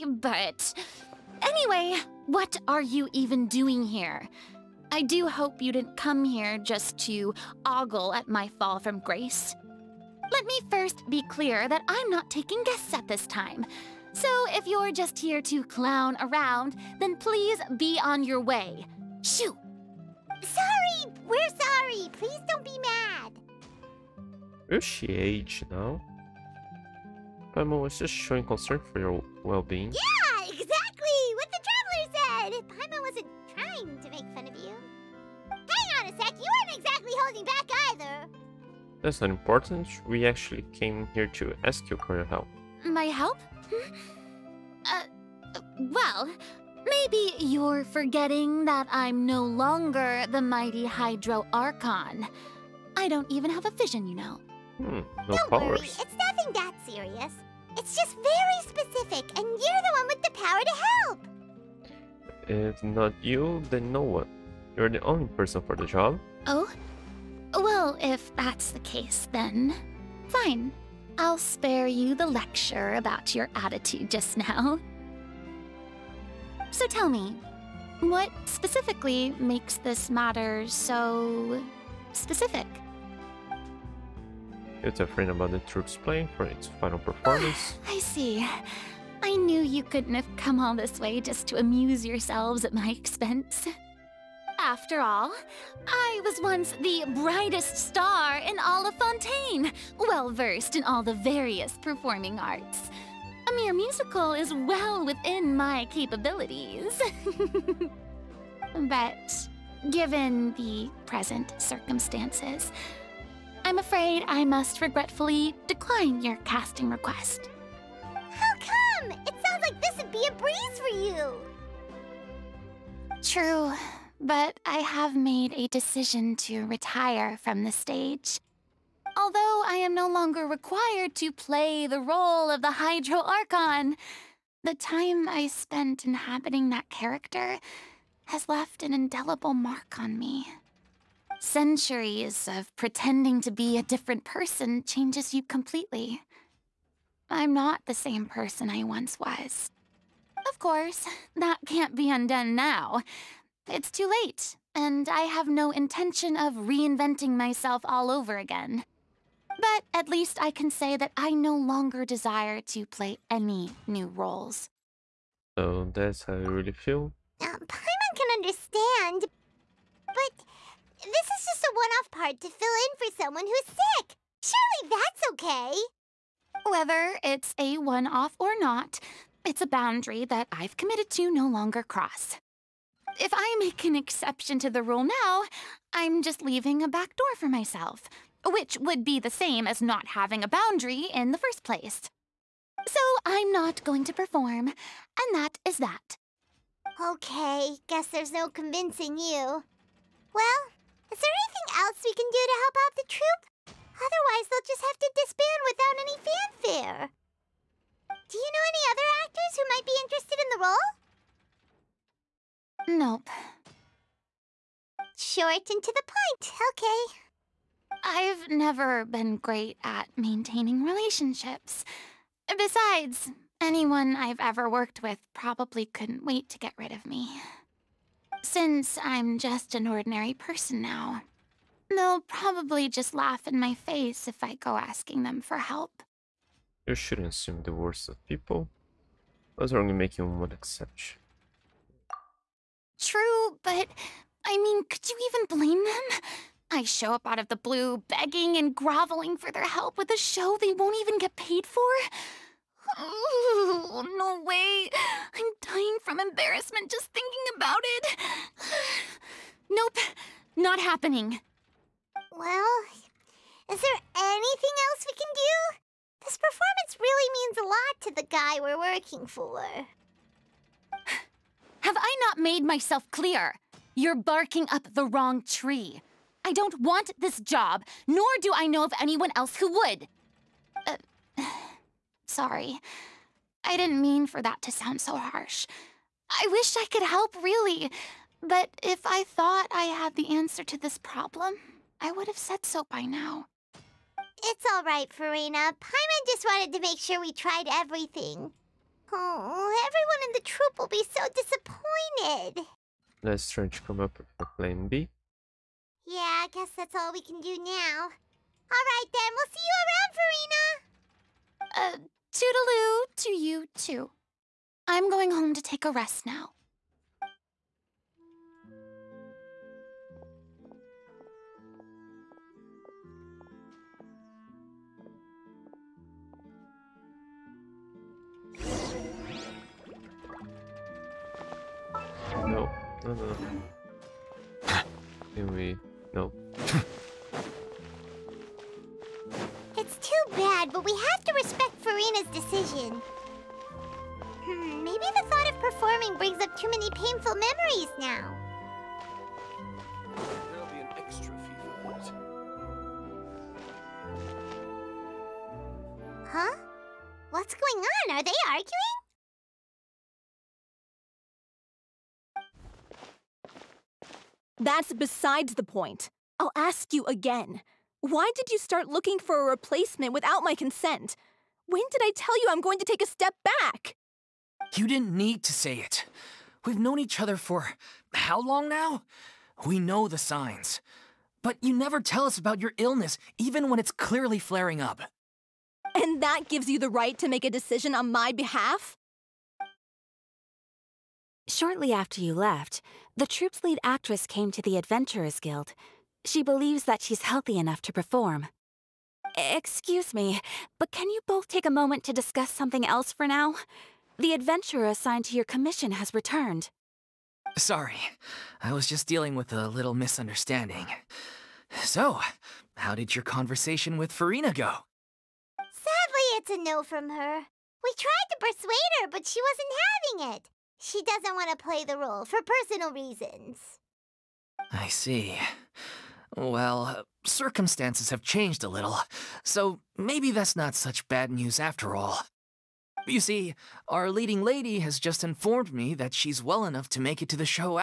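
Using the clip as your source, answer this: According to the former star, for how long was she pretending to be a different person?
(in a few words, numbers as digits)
Centuries.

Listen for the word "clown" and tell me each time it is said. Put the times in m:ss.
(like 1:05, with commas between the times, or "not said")
0:15.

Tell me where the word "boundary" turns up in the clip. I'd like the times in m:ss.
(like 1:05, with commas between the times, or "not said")
2:59, 3:10.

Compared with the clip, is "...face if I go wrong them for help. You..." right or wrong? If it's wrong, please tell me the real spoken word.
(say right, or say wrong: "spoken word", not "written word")
wrong: "asking", not "wrong".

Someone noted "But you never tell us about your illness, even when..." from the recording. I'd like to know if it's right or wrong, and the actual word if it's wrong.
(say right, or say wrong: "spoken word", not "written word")
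right.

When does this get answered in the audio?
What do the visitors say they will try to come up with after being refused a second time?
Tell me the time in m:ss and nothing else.
5:04.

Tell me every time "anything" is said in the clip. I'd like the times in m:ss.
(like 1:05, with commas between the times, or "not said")
3:21, 4:24.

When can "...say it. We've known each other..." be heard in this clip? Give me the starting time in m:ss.
6:15.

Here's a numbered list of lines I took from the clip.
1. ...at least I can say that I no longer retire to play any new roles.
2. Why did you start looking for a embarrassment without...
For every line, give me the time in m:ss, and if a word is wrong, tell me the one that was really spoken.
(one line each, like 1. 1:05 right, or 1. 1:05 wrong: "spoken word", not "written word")
1. 2:39 wrong: "desire", not "retire"
2. 6:08 wrong: "replacement", not "embarrassment".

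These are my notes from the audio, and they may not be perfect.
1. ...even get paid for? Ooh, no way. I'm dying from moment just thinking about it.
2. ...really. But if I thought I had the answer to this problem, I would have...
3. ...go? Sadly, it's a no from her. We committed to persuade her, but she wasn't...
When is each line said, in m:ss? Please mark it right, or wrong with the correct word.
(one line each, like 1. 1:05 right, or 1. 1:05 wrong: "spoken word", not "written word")
1. 4:11 wrong: "embarrassment", not "moment"
2. 4:47 right
3. 6:54 wrong: "tried", not "committed".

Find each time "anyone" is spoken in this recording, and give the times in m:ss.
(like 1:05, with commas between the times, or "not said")
3:43, 4:39.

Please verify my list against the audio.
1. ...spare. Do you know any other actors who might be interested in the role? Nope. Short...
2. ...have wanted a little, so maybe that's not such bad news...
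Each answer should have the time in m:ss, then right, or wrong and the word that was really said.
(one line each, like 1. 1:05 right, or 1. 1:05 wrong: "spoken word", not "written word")
1. 3:26 wrong: "fanfare", not "spare"
2. 7:08 wrong: "changed", not "wanted".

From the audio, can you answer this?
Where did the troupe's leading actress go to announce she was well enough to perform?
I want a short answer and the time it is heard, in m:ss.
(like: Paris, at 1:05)
Adventurers Guild, at 6:34.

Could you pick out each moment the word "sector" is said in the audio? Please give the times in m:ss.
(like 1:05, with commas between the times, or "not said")
not said.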